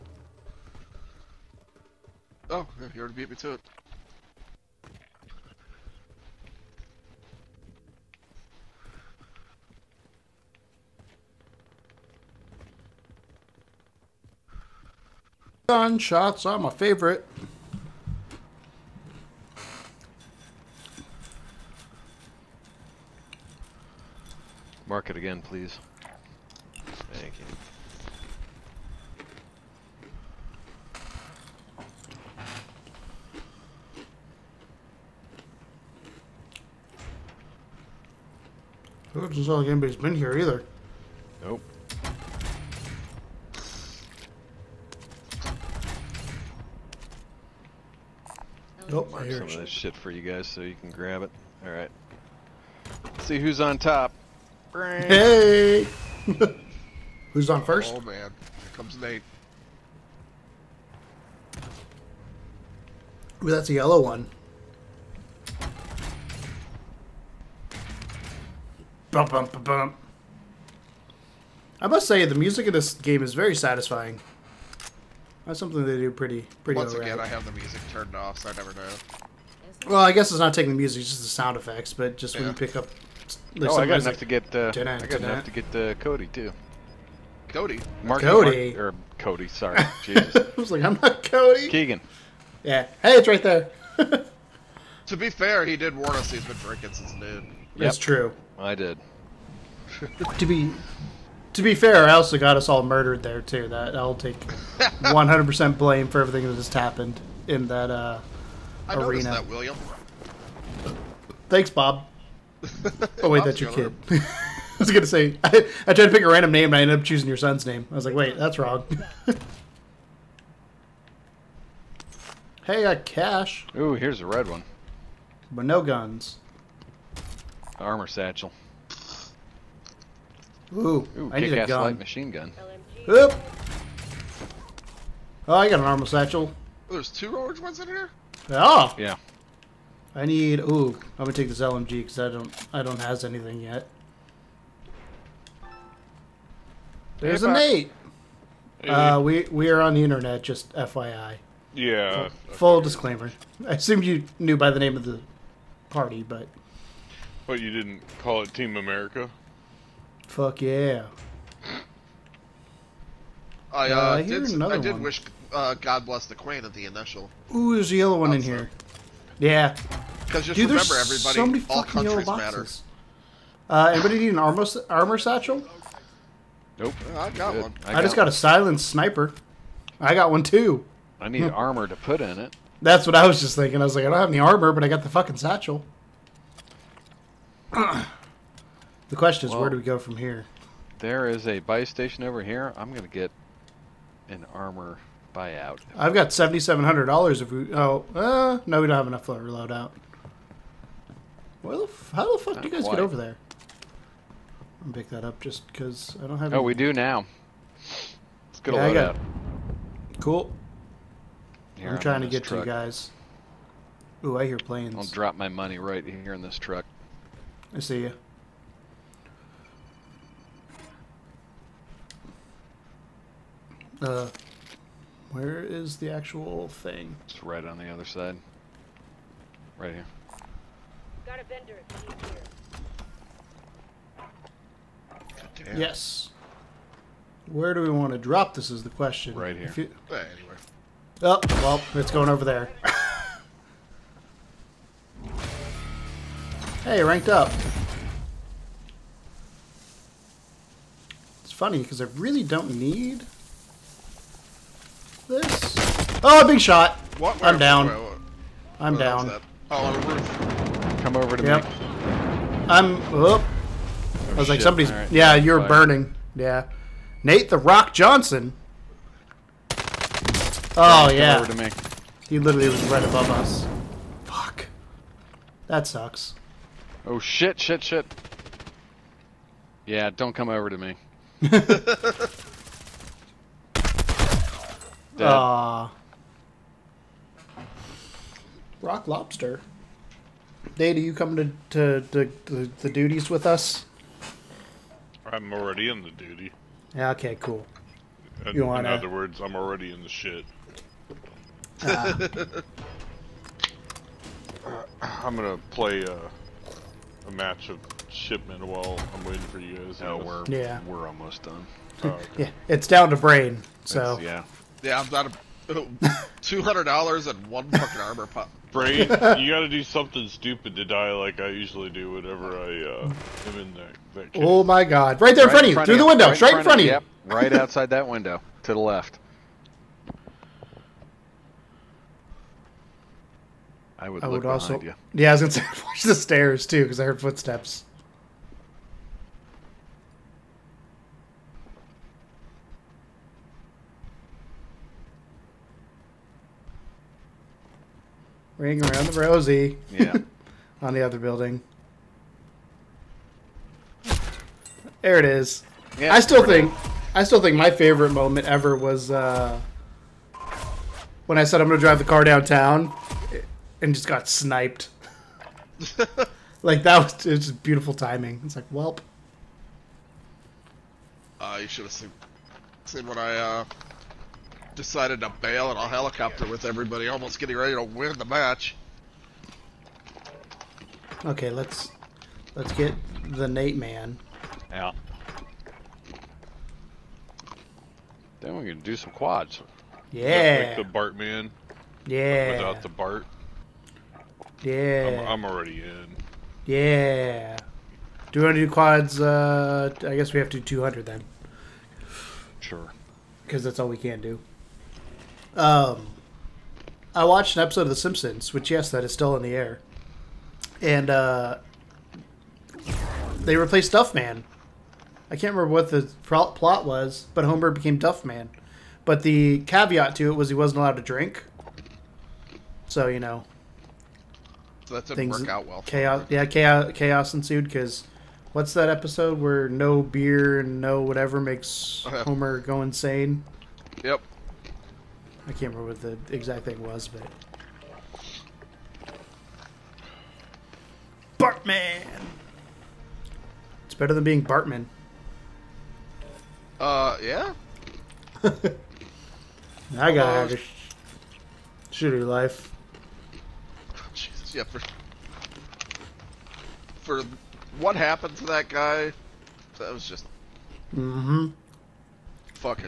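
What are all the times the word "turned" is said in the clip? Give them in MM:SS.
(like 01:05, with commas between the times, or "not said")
01:17.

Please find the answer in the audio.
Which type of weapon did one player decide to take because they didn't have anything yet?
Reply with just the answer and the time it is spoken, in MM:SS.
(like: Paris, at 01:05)
LMG, at 02:21.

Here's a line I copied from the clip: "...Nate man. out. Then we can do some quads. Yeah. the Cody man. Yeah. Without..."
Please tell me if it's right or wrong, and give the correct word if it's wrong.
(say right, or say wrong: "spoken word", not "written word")
wrong: "Bart", not "Cody".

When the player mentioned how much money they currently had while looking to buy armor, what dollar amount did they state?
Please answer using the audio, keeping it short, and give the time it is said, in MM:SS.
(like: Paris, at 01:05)
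$7,700, at 03:16.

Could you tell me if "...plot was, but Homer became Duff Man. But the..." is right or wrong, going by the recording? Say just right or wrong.
right.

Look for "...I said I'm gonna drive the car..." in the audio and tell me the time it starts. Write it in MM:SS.
06:01.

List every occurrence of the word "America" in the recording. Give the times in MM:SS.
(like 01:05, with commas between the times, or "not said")
02:38.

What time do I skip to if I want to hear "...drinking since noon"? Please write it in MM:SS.
01:36.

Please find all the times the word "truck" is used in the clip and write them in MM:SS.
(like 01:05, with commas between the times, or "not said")
03:32, 03:36.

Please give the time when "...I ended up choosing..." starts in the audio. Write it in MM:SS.
01:56.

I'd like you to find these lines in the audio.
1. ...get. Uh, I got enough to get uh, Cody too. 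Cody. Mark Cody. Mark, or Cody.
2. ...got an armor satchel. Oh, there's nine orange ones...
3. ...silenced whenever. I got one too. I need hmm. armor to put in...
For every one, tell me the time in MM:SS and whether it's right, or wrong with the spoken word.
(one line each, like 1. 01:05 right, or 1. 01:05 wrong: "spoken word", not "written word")
1. 01:24 right
2. 02:15 wrong: "two", not "nine"
3. 02:58 wrong: "sniper", not "whenever".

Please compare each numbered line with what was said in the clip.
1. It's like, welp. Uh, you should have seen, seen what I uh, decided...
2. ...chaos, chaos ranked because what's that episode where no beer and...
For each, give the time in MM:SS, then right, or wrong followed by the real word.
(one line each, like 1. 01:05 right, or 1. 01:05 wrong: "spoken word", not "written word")
1. 06:08 right
2. 07:06 wrong: "ensued", not "ranked".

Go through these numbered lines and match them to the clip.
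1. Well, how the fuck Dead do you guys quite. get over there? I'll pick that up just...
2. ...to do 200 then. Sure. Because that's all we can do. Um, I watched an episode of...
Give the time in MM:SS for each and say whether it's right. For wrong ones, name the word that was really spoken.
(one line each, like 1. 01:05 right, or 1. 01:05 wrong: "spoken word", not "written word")
1. 03:21 wrong: "Not", not "Dead"
2. 06:40 right.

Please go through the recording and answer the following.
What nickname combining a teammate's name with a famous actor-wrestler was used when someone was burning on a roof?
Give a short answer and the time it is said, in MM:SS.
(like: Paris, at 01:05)
Nate the Rock Johnson, at 04:27.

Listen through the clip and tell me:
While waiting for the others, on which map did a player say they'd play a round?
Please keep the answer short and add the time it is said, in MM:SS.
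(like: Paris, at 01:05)
Shipment, at 05:08.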